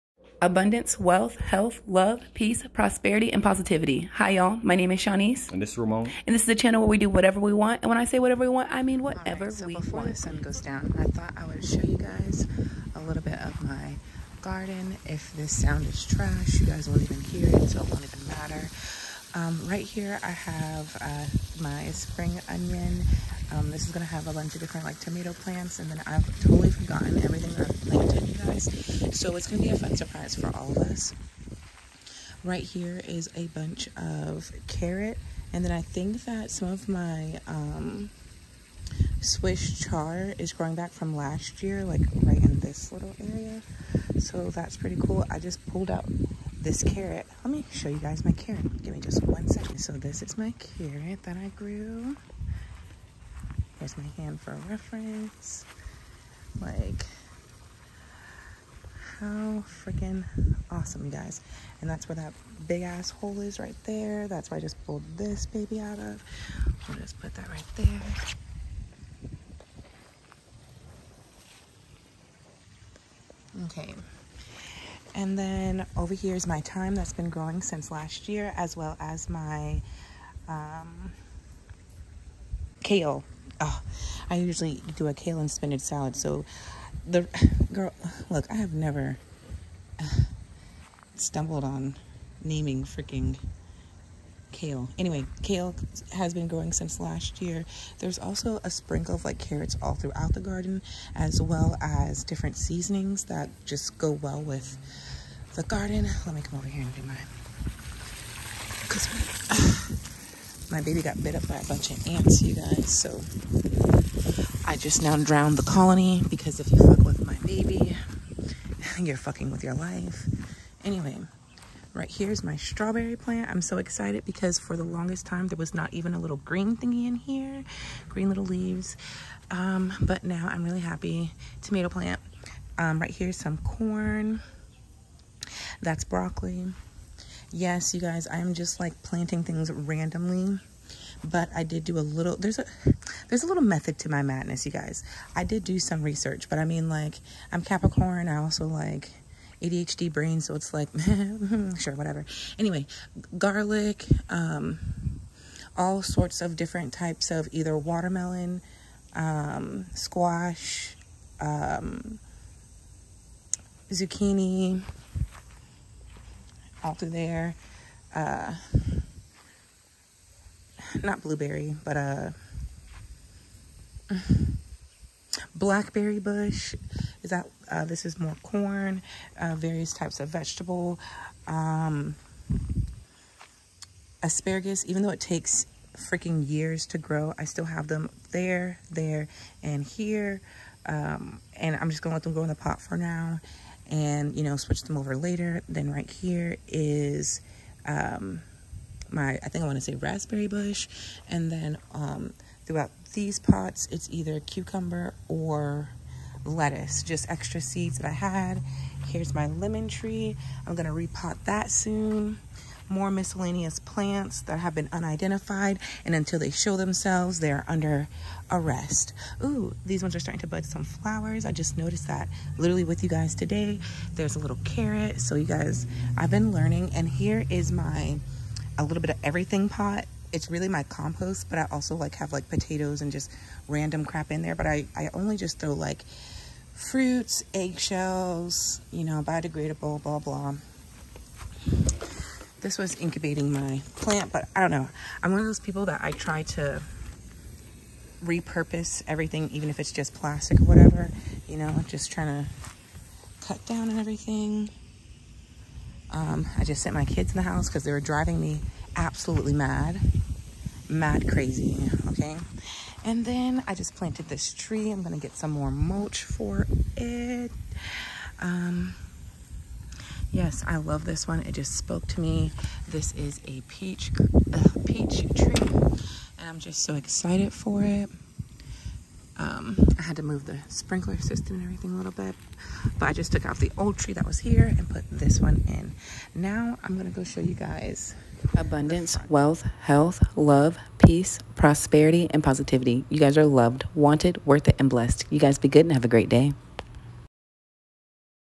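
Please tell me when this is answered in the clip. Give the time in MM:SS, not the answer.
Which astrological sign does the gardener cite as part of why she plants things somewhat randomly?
02:27.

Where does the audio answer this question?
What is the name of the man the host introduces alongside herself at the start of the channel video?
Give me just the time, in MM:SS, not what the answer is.
00:05.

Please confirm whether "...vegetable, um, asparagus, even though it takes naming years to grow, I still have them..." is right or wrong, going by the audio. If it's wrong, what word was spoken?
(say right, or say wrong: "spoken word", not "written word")
wrong: "freaking", not "naming".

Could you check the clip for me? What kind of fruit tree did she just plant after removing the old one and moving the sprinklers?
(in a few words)
Peach tree.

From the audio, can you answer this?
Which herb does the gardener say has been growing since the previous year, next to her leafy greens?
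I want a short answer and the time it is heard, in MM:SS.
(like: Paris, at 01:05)
Thyme, at 01:16.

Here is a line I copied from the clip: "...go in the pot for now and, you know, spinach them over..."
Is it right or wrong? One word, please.
wrong.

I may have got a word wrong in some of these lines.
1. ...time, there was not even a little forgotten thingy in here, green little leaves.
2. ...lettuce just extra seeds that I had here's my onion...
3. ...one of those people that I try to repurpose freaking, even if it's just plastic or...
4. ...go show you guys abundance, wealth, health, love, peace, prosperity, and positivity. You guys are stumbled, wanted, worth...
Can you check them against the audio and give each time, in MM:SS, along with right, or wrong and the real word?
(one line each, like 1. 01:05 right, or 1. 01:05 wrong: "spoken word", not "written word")
1. 02:05 wrong: "green", not "forgotten"
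2. 03:26 wrong: "lemon", not "onion"
3. 04:05 wrong: "everything", not "freaking"
4. 04:47 wrong: "loved", not "stumbled".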